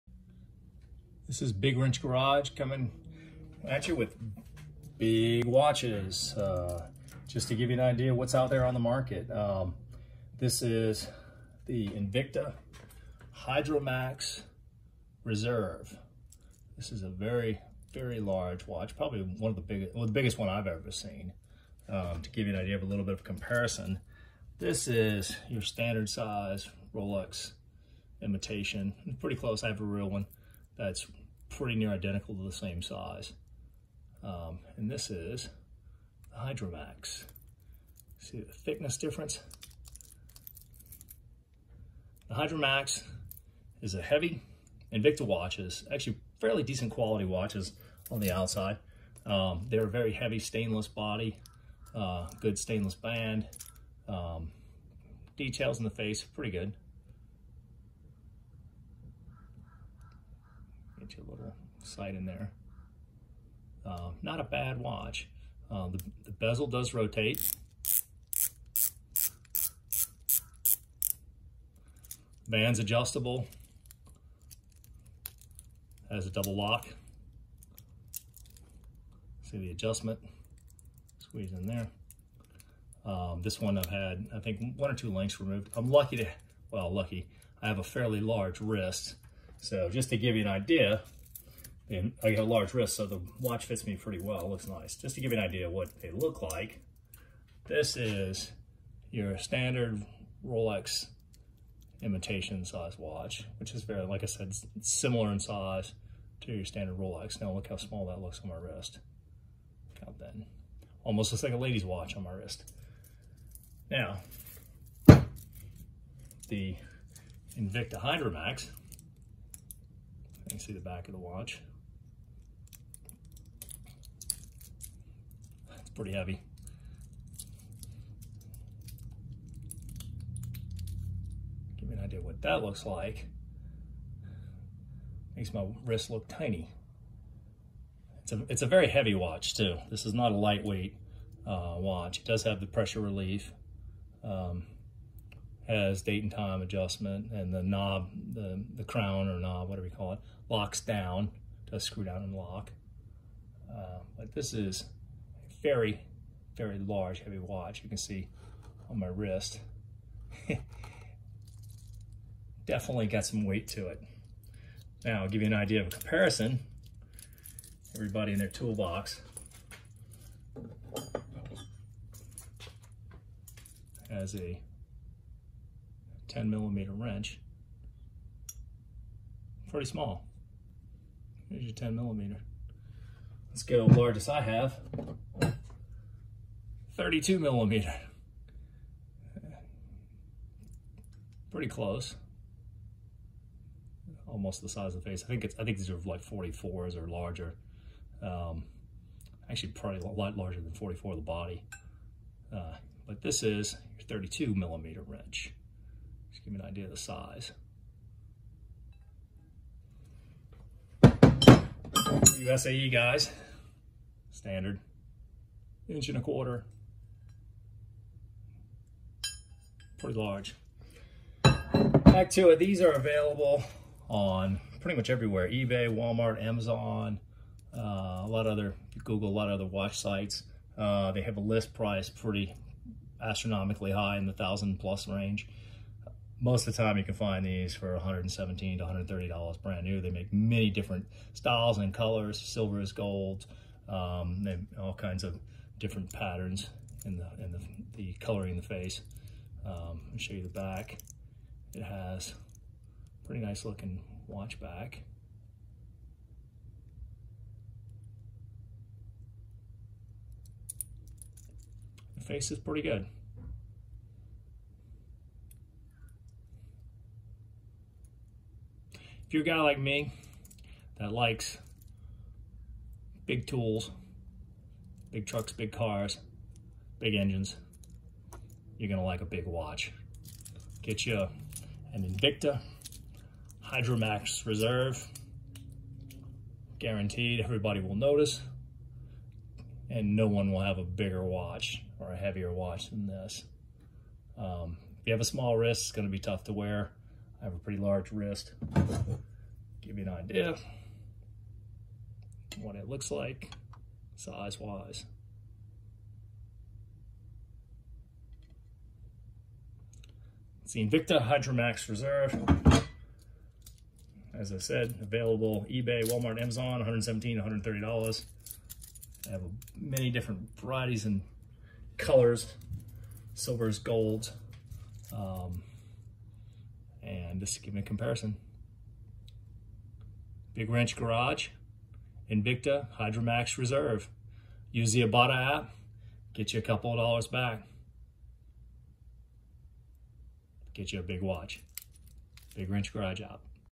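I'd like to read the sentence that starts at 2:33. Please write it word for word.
Um, but this is a very, very large, heavy watch.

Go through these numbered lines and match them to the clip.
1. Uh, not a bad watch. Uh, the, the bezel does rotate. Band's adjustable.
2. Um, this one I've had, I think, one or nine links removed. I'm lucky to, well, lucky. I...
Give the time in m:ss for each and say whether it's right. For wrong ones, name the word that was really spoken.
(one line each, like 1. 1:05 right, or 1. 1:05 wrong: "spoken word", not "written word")
1. 1:03 right
2. 1:23 wrong: "two", not "nine".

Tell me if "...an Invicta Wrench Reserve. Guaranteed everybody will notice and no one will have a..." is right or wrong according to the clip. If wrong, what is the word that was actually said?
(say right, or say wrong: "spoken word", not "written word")
wrong: "Hydromax", not "Wrench".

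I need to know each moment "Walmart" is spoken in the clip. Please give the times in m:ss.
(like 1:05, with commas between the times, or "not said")
3:45, 5:16.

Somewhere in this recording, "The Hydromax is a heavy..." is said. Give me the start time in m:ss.
0:42.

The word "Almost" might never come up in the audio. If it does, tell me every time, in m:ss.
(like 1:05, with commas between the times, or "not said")
1:51, 3:14.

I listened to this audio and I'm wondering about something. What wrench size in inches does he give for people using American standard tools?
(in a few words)
inch and a quarter.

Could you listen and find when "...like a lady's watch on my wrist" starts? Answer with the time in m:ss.
1:51.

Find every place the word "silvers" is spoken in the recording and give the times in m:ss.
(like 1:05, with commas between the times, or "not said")
4:02, 5:23.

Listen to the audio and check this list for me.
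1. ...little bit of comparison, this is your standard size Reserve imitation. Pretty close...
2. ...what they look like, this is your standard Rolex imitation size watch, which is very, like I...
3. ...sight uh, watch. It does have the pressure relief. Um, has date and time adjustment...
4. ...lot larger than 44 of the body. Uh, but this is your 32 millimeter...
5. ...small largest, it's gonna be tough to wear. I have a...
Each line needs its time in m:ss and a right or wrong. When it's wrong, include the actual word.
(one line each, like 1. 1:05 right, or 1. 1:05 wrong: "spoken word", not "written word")
1. 0:22 wrong: "Rolex", not "Reserve"
2. 1:35 right
3. 2:20 wrong: "lightweight", not "sight"
4. 3:20 right
5. 4:55 wrong: "wrist", not "largest".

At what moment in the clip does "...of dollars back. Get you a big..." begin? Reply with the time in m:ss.
5:36.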